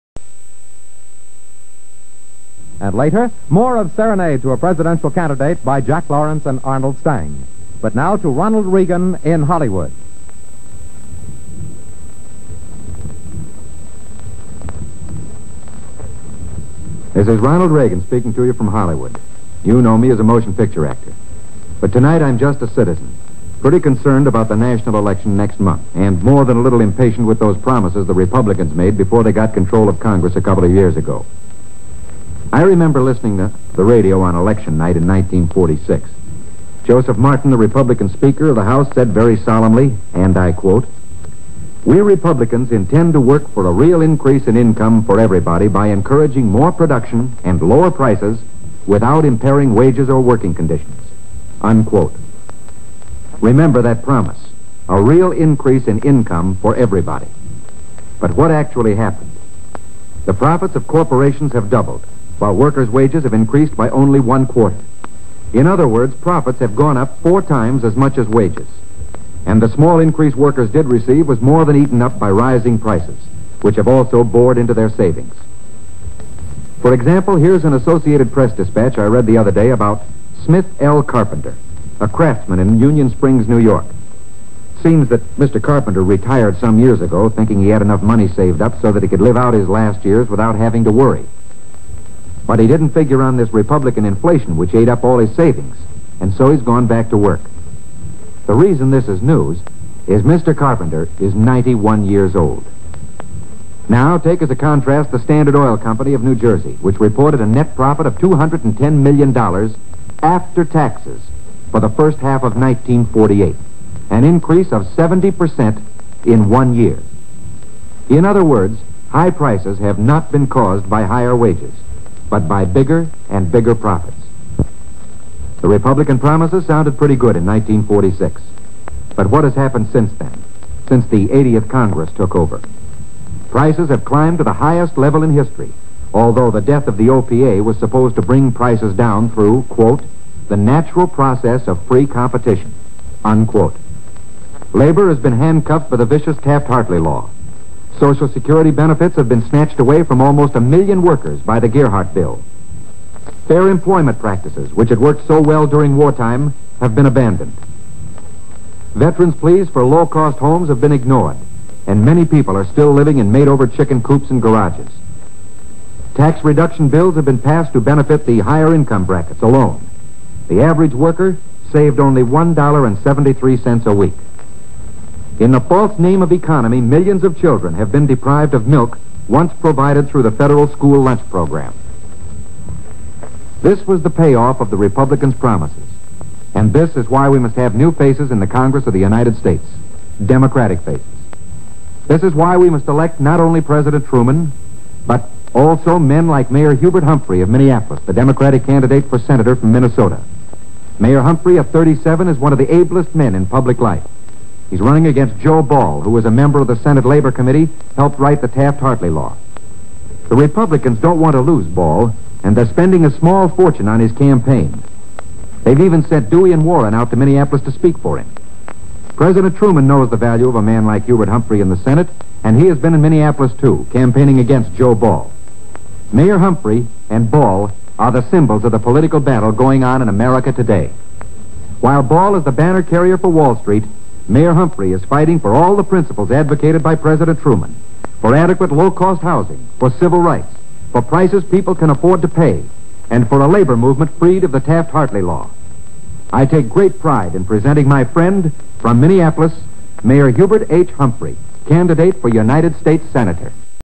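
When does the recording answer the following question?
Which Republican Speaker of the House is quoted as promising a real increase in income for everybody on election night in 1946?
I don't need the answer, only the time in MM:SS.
00:36.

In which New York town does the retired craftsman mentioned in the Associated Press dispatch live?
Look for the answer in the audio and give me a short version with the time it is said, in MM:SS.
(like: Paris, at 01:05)
Union Springs, at 01:22.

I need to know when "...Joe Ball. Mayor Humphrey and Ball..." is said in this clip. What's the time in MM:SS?
03:44.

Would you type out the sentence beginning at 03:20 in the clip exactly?
Mayor Humphrey of 37 is one of the ablest men in public life.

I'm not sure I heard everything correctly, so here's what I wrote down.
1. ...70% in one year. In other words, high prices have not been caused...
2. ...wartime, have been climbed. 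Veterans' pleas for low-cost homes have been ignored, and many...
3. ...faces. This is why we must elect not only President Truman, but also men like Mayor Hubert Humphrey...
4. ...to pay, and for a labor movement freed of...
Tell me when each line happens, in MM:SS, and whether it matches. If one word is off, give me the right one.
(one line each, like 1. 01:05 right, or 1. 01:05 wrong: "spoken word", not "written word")
1. 01:54 right
2. 02:35 wrong: "abandoned", not "climbed"
3. 03:10 right
4. 04:02 right.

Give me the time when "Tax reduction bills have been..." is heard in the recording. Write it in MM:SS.
02:46.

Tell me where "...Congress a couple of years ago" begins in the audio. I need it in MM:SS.
00:29.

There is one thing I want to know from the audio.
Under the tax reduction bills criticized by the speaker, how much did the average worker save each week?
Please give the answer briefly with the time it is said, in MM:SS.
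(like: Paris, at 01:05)
$1.73, at 02:52.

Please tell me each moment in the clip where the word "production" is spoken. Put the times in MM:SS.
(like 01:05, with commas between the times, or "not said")
00:46.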